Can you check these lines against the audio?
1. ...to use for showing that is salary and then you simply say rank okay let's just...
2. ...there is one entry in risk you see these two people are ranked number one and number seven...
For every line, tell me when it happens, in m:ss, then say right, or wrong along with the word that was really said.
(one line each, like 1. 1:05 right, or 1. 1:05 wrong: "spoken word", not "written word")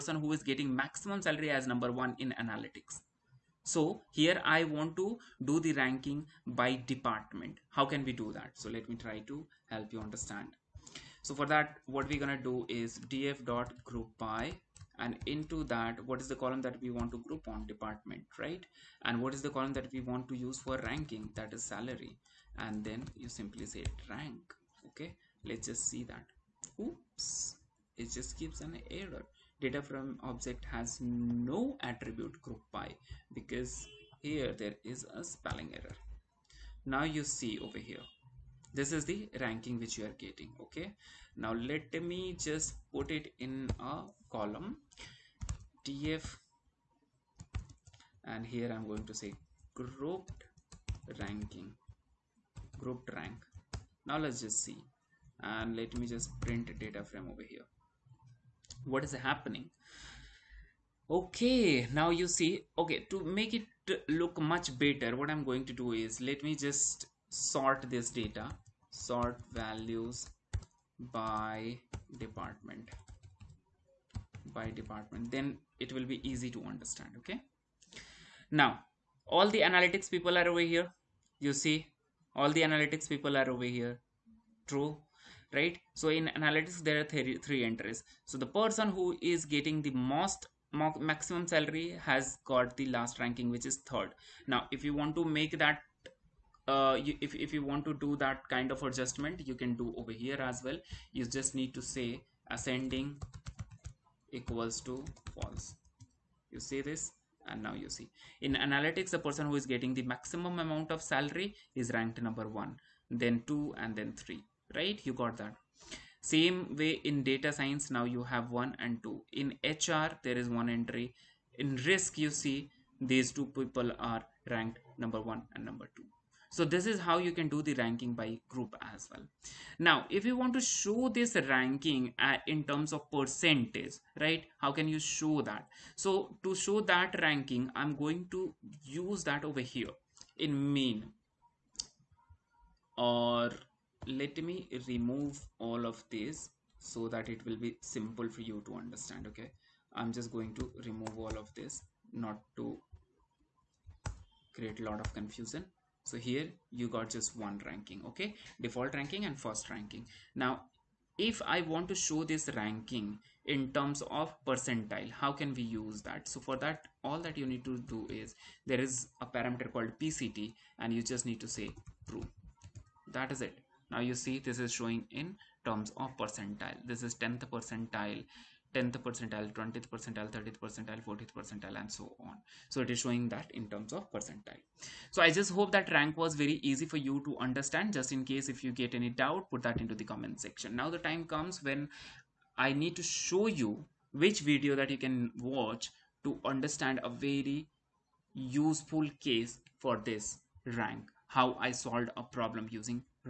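1. 0:20 wrong: "ranking", not "showing"
2. 2:00 wrong: "two", not "seven".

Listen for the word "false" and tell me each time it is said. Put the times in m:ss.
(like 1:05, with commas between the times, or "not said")
1:45.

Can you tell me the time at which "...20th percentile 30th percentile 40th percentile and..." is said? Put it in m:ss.
2:59.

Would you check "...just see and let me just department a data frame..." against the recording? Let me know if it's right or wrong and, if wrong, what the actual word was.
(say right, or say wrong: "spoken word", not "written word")
wrong: "print", not "department".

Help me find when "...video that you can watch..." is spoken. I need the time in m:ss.
3:14.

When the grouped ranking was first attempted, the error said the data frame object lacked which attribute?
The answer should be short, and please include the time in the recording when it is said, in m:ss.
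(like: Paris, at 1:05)
group by, at 0:32.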